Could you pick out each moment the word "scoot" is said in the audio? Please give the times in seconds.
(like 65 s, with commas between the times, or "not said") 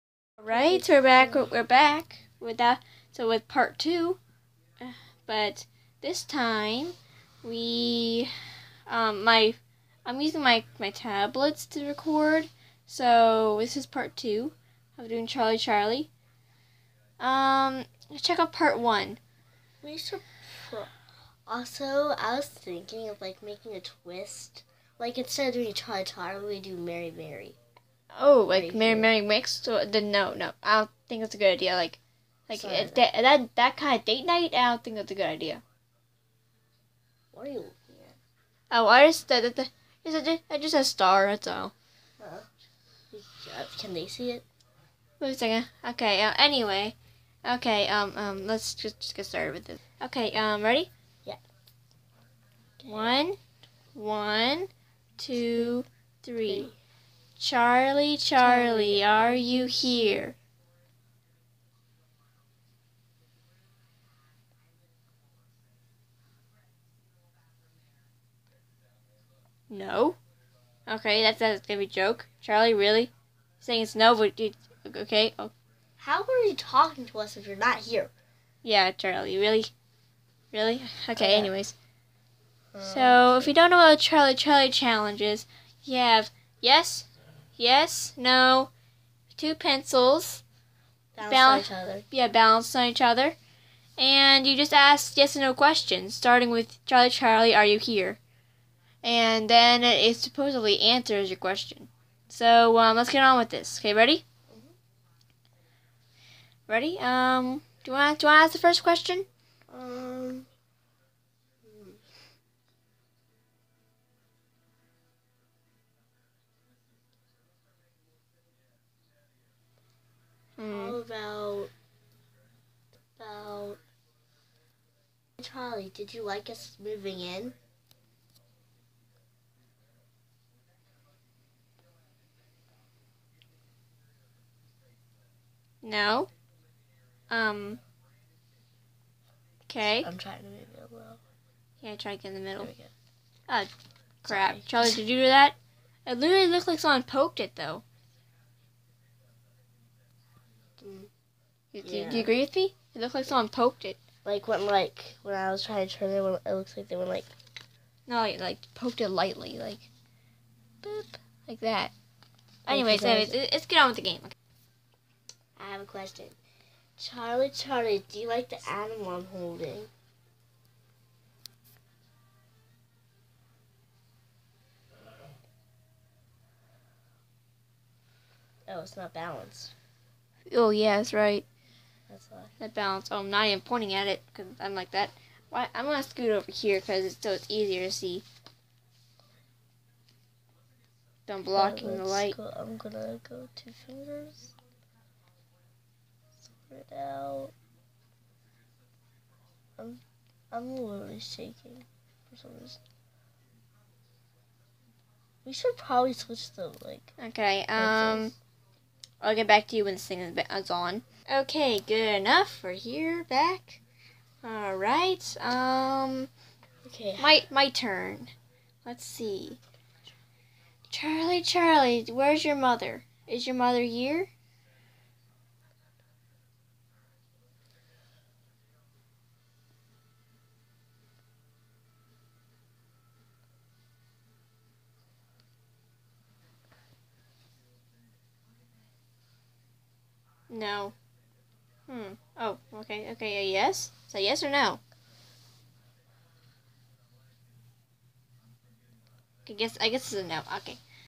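186 s.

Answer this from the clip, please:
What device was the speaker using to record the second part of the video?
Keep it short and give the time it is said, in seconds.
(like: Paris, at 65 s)
tablets, at 10 s.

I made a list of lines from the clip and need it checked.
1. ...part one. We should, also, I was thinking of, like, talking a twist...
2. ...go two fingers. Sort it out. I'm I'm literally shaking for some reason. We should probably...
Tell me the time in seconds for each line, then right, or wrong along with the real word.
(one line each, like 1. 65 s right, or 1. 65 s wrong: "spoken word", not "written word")
1. 18 s wrong: "making", not "talking"
2. 193 s right.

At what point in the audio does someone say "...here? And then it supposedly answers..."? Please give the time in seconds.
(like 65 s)
97 s.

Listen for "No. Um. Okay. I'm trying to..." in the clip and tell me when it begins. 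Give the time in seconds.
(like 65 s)
135 s.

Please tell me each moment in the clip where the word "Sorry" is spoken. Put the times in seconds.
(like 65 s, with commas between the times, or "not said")
32 s, 144 s.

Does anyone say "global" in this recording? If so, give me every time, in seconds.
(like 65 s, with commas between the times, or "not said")
not said.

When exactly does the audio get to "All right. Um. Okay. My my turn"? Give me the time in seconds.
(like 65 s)
214 s.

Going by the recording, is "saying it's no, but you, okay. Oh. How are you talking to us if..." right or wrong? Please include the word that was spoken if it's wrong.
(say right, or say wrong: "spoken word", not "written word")
right.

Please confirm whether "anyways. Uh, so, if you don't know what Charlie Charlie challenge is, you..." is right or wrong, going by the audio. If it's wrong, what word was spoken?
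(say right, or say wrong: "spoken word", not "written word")
right.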